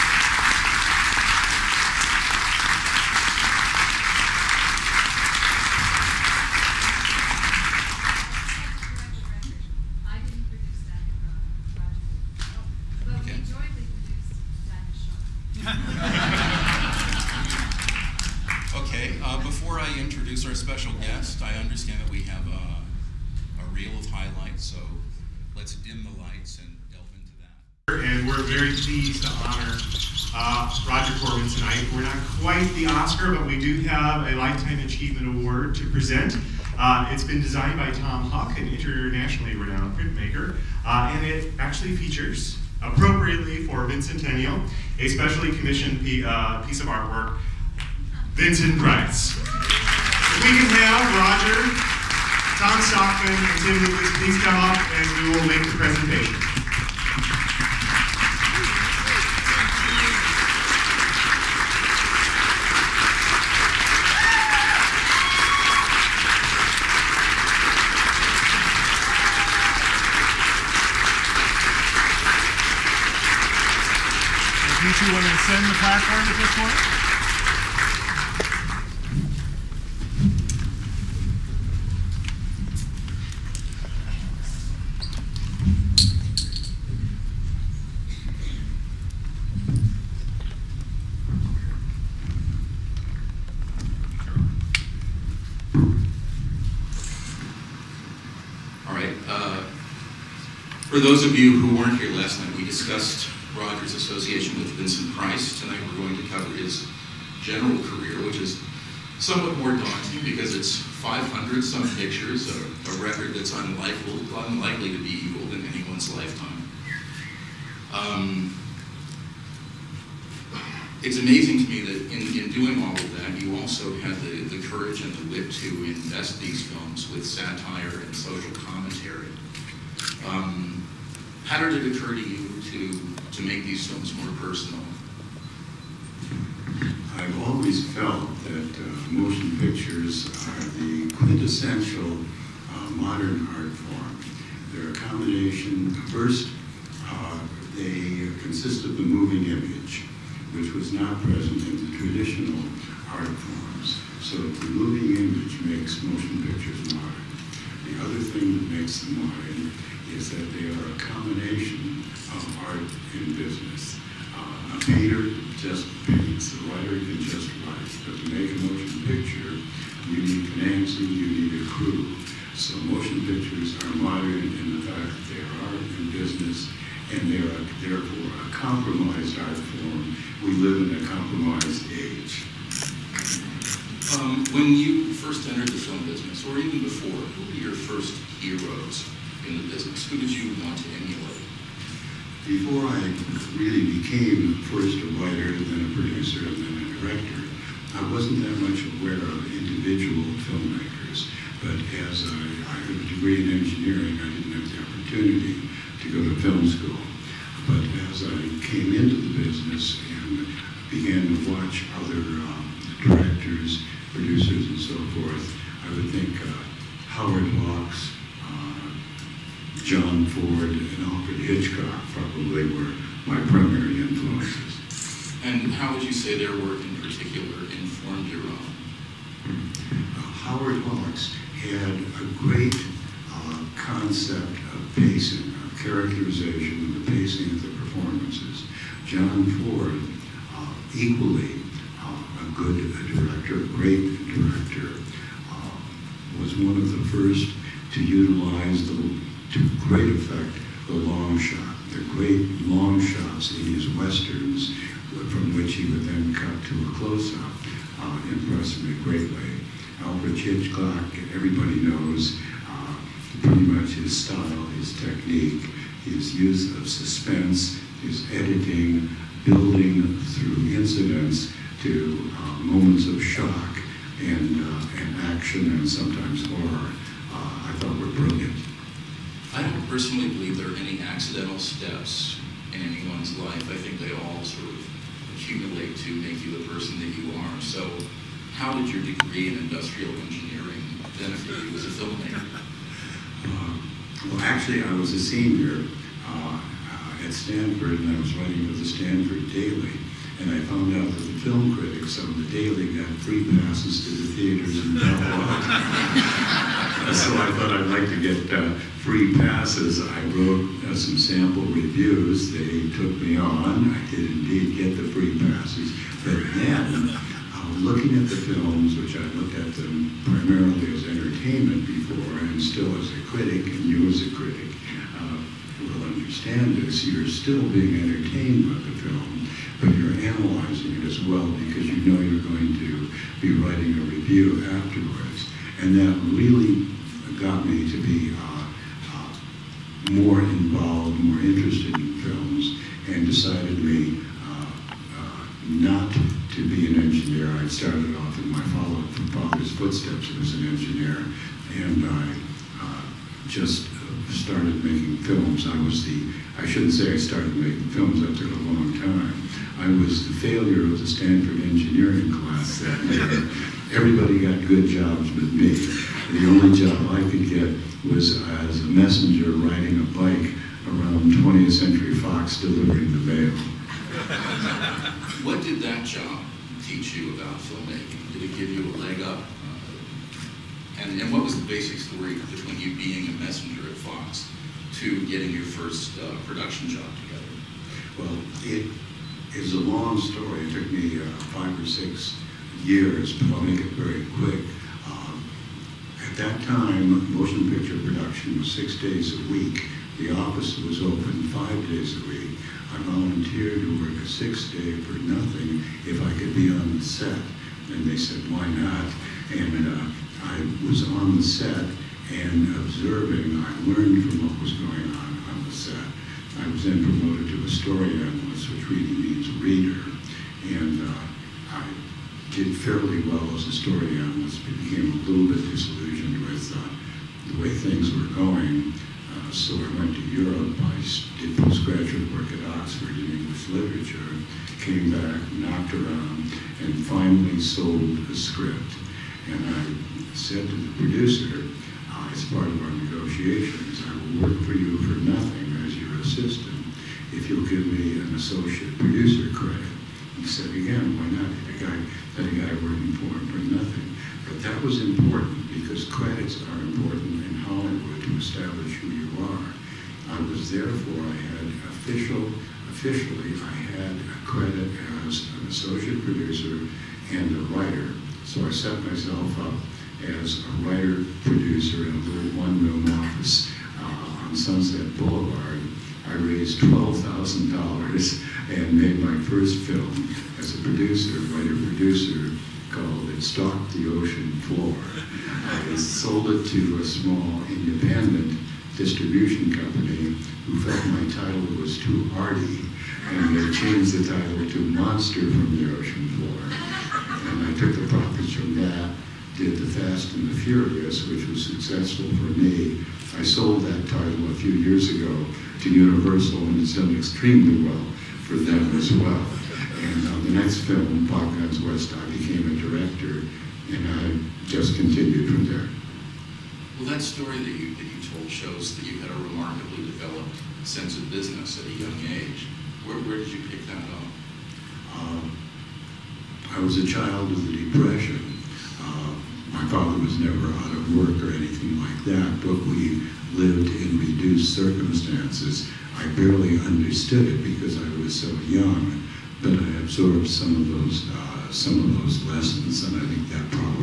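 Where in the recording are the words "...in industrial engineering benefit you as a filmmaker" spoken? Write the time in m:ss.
4:49.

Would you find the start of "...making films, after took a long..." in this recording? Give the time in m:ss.
5:57.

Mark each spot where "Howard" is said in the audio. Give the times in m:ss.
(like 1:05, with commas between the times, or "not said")
3:37, 3:50.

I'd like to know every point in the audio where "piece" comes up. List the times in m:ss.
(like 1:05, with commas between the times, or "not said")
0:46.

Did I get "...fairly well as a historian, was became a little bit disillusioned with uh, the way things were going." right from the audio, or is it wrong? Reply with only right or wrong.
right.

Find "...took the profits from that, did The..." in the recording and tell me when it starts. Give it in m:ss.
8:17.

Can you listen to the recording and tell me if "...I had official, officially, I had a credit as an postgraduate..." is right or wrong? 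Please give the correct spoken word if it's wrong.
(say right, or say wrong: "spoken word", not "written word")
wrong: "associate", not "postgraduate".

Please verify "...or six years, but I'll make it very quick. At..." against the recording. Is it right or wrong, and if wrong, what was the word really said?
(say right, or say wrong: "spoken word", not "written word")
right.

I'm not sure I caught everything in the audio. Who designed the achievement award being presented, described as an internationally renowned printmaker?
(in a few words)
Tom Huck.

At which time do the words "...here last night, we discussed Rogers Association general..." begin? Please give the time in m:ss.
1:41.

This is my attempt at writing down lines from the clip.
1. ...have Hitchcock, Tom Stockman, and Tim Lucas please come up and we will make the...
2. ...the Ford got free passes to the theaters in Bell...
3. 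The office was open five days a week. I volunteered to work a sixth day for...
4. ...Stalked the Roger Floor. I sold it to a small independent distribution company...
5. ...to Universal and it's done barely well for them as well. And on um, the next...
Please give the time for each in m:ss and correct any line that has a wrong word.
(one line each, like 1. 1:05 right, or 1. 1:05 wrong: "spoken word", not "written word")
1. 0:50 wrong: "Roger", not "Hitchcock"
2. 5:02 wrong: "Daily", not "Ford"
3. 6:40 right
4. 8:03 wrong: "Ocean", not "Roger"
5. 8:25 wrong: "extremely", not "barely".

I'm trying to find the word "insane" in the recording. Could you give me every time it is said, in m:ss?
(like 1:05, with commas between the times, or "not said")
not said.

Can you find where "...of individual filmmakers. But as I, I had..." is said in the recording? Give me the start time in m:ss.
3:19.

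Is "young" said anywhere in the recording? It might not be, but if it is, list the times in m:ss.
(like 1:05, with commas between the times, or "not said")
8:41, 8:58.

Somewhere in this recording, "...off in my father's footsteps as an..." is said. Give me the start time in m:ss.
5:48.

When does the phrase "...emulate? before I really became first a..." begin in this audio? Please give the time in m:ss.
3:10.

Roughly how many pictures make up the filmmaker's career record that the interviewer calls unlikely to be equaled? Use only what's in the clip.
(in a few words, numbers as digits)
500.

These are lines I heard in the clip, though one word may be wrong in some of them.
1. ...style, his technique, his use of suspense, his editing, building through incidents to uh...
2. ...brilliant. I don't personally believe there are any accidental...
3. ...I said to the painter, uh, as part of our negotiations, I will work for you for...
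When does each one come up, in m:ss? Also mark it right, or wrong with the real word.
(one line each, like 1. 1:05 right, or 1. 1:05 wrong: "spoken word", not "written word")
1. 4:24 right
2. 4:38 right
3. 7:19 wrong: "producer", not "painter".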